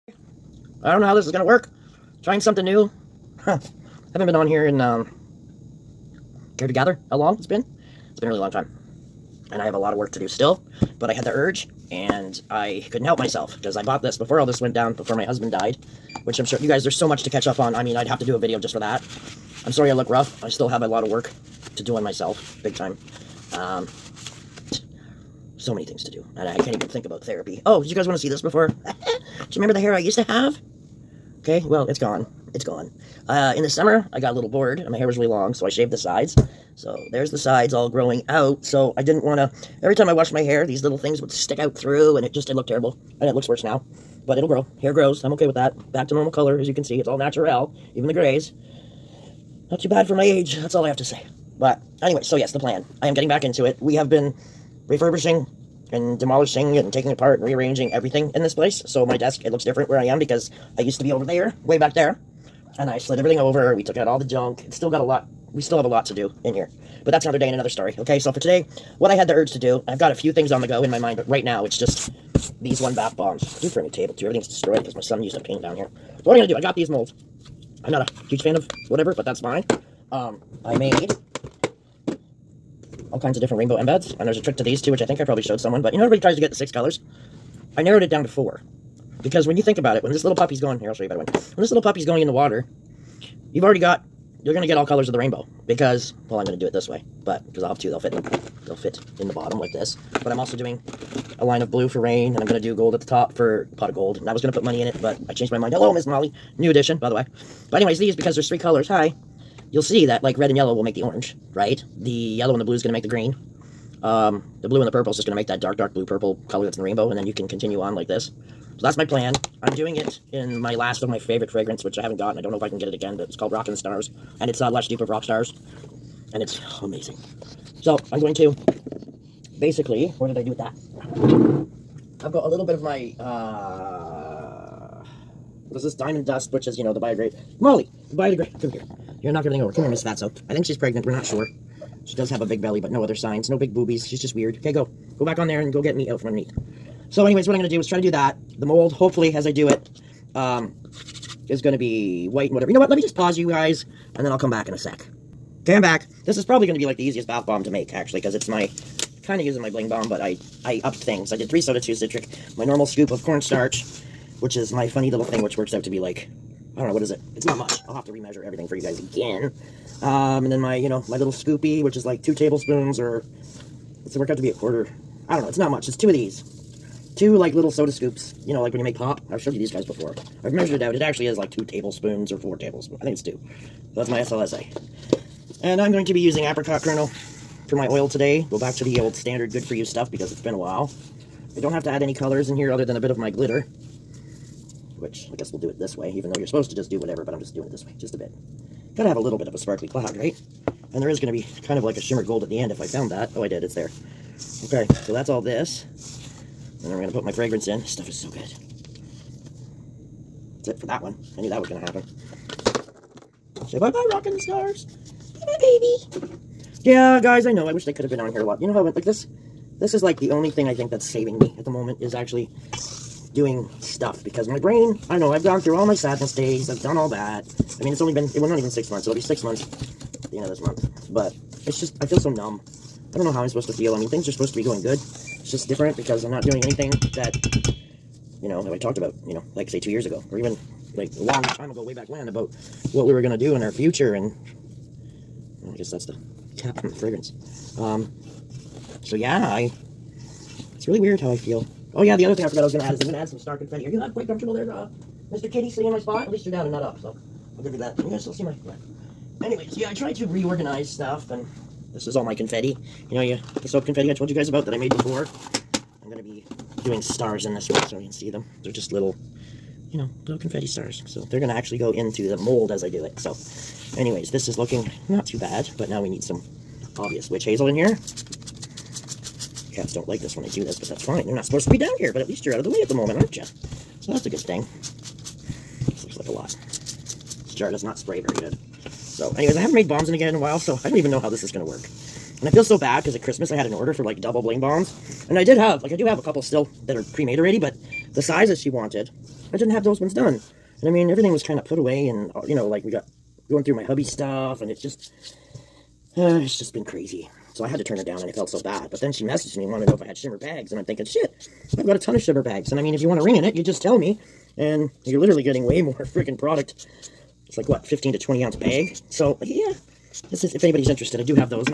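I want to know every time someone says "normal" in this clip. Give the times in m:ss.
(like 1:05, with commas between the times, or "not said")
0:46, 2:42.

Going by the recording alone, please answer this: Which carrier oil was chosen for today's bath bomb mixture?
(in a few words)
Apricot kernel.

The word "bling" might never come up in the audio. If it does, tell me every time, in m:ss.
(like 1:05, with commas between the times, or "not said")
2:39, 4:54.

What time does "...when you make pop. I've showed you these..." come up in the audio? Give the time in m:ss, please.
2:58.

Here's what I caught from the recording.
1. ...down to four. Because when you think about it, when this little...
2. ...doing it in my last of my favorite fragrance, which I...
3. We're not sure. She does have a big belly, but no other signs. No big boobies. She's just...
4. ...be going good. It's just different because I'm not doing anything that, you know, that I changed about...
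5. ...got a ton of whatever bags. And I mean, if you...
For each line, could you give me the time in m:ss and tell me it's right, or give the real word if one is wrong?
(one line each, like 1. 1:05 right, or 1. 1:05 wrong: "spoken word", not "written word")
1. 1:28 right
2. 1:59 right
3. 2:21 right
4. 3:54 wrong: "talked", not "changed"
5. 5:11 wrong: "shimmer", not "whatever".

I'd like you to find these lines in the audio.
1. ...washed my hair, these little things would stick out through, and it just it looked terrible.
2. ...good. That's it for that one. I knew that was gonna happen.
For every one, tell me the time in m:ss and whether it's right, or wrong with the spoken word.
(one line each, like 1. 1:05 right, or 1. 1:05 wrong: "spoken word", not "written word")
1. 0:40 right
2. 3:28 right.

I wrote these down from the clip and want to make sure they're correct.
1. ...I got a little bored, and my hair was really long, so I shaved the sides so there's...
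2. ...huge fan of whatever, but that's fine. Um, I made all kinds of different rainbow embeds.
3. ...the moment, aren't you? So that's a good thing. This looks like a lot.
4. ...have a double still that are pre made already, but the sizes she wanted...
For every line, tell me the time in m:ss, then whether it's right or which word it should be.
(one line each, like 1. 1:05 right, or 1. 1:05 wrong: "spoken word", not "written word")
1. 0:34 right
2. 1:18 right
3. 4:42 right
4. 4:56 wrong: "couple", not "double".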